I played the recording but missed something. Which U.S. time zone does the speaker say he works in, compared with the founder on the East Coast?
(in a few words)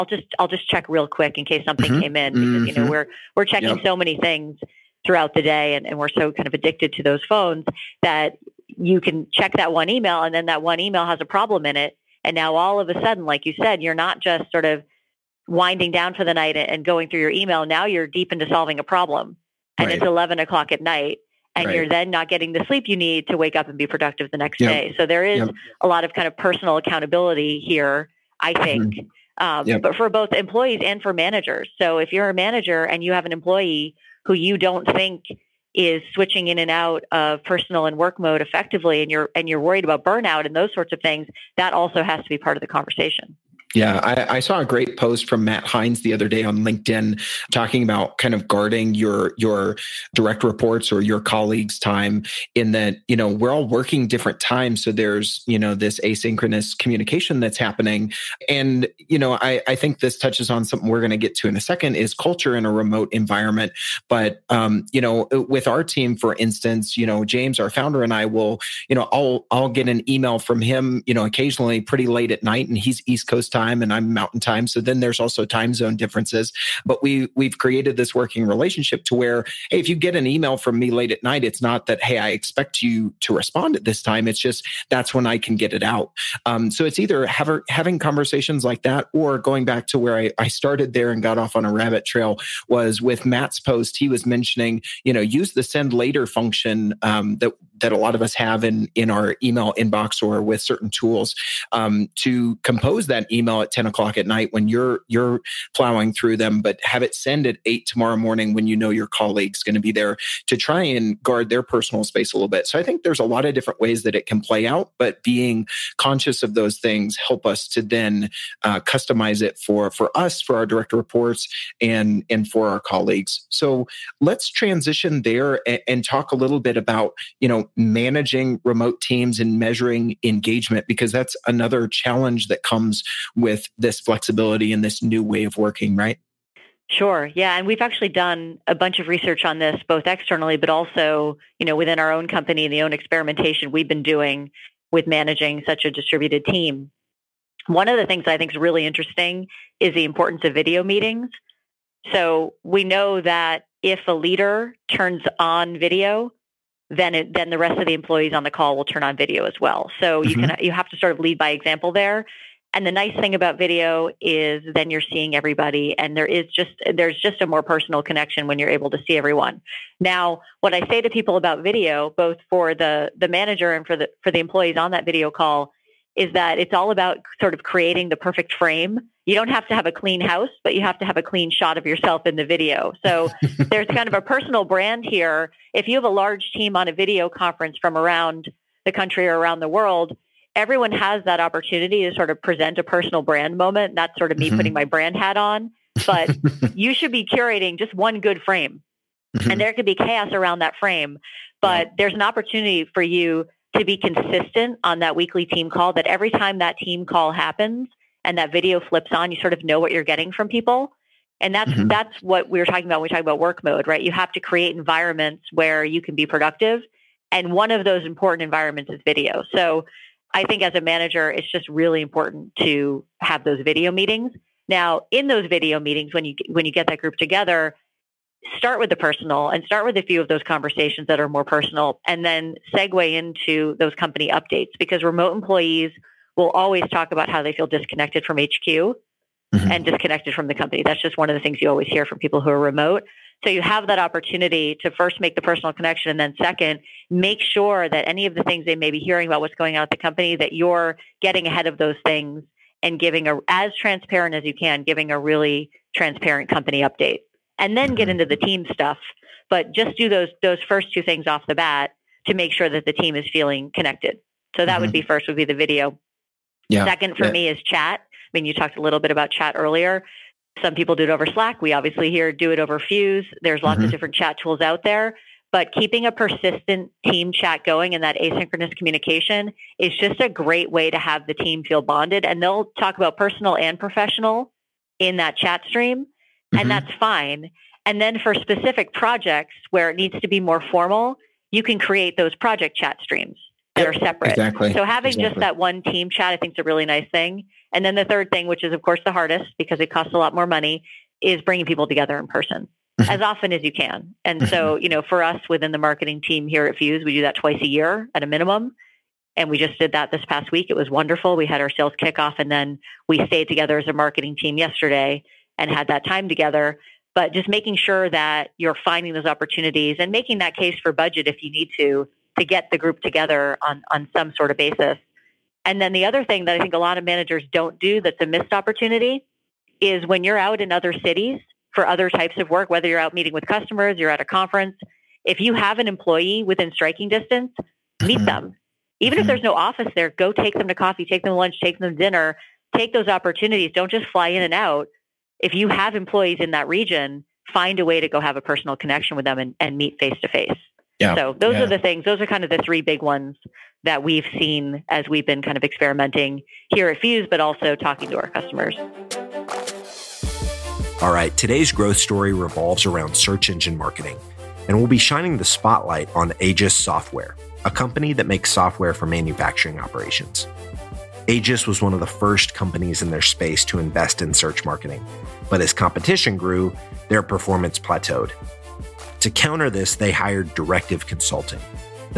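Mountain time.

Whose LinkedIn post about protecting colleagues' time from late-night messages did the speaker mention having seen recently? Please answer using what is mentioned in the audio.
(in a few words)
Matt Hines.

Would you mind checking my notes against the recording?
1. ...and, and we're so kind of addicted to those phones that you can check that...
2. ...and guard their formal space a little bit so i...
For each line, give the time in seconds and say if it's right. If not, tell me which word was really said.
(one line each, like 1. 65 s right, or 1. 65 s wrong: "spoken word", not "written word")
1. 5 s right
2. 110 s wrong: "personal", not "formal".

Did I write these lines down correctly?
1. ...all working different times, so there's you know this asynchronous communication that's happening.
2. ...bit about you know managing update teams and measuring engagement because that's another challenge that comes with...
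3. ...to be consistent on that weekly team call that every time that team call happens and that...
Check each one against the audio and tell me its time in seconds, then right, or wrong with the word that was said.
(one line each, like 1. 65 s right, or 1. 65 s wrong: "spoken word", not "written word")
1. 53 s right
2. 126 s wrong: "remote", not "update"
3. 203 s right.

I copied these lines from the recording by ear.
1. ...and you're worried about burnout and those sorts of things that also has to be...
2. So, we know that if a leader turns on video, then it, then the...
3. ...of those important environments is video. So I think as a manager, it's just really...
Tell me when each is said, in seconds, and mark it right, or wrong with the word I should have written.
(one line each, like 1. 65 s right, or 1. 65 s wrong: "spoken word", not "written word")
1. 39 s right
2. 152 s right
3. 217 s right.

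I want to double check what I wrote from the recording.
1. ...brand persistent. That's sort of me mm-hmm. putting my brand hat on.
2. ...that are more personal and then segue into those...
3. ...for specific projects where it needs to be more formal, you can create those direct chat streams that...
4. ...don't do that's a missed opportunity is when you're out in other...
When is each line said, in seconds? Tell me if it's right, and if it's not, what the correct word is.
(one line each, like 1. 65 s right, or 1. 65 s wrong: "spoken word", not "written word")
1. 193 s wrong: "moment", not "persistent"
2. 231 s right
3. 288 s wrong: "project", not "direct"
4. 327 s right.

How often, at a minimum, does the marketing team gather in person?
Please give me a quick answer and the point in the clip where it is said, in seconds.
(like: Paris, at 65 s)
Twice a year, at 307 s.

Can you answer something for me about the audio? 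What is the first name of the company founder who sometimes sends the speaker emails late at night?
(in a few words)
James.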